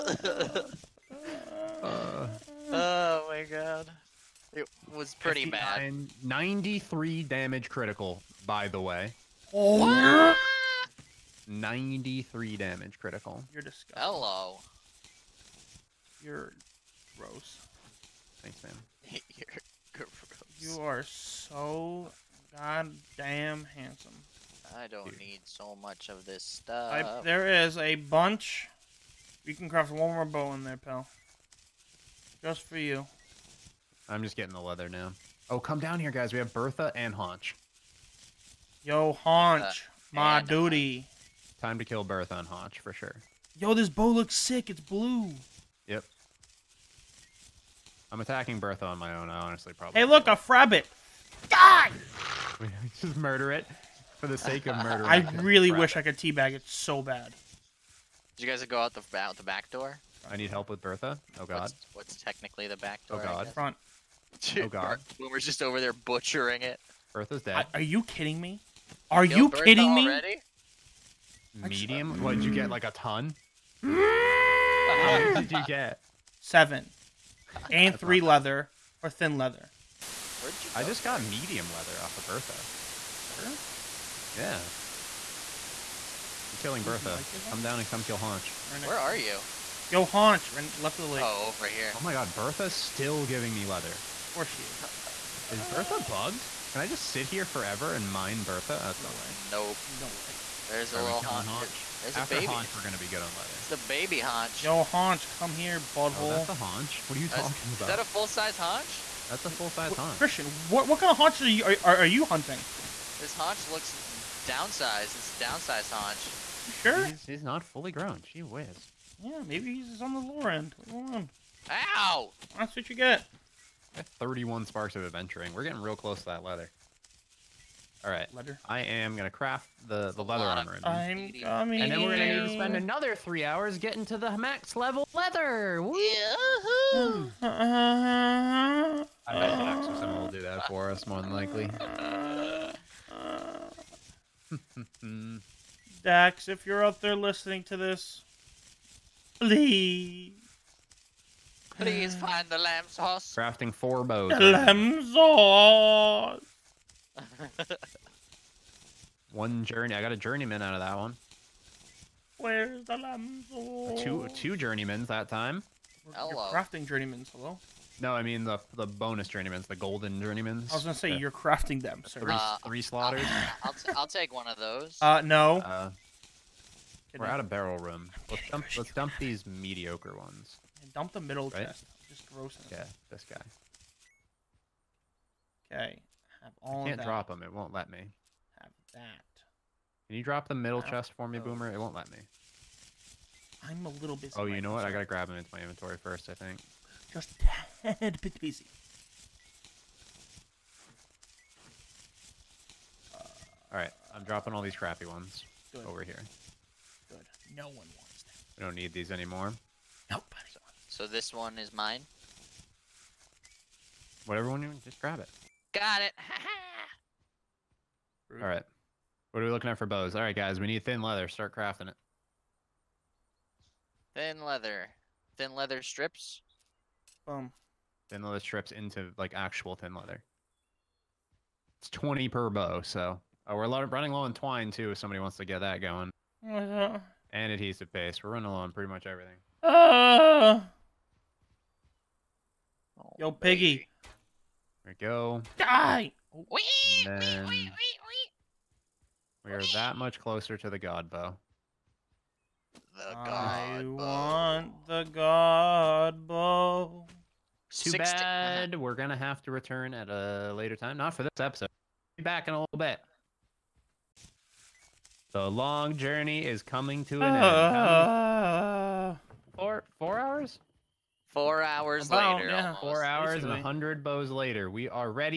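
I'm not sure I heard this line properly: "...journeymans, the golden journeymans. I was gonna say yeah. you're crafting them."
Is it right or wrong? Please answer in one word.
right.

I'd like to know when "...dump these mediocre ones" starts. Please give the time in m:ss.
2:58.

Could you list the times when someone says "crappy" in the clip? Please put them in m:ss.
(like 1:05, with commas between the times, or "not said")
3:24.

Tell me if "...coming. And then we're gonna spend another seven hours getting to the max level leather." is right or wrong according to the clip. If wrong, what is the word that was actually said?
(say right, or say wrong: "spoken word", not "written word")
wrong: "three", not "seven".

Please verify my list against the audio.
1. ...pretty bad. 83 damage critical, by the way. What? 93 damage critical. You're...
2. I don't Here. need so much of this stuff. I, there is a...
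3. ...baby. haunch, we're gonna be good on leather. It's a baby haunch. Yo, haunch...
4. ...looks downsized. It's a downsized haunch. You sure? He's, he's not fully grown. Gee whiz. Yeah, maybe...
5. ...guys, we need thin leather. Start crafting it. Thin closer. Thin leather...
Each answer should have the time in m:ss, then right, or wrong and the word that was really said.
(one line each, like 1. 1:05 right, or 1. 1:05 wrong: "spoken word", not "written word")
1. 0:05 wrong: "93", not "83"
2. 0:24 right
3. 1:42 right
4. 1:53 right
5. 3:40 wrong: "leather", not "closer".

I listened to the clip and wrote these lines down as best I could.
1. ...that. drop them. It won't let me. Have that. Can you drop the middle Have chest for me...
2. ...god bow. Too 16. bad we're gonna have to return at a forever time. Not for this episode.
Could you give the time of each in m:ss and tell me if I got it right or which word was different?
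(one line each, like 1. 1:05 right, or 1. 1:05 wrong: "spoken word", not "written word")
1. 3:06 right
2. 4:15 wrong: "later", not "forever".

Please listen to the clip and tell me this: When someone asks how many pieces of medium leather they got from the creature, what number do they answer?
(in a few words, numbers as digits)
Seven.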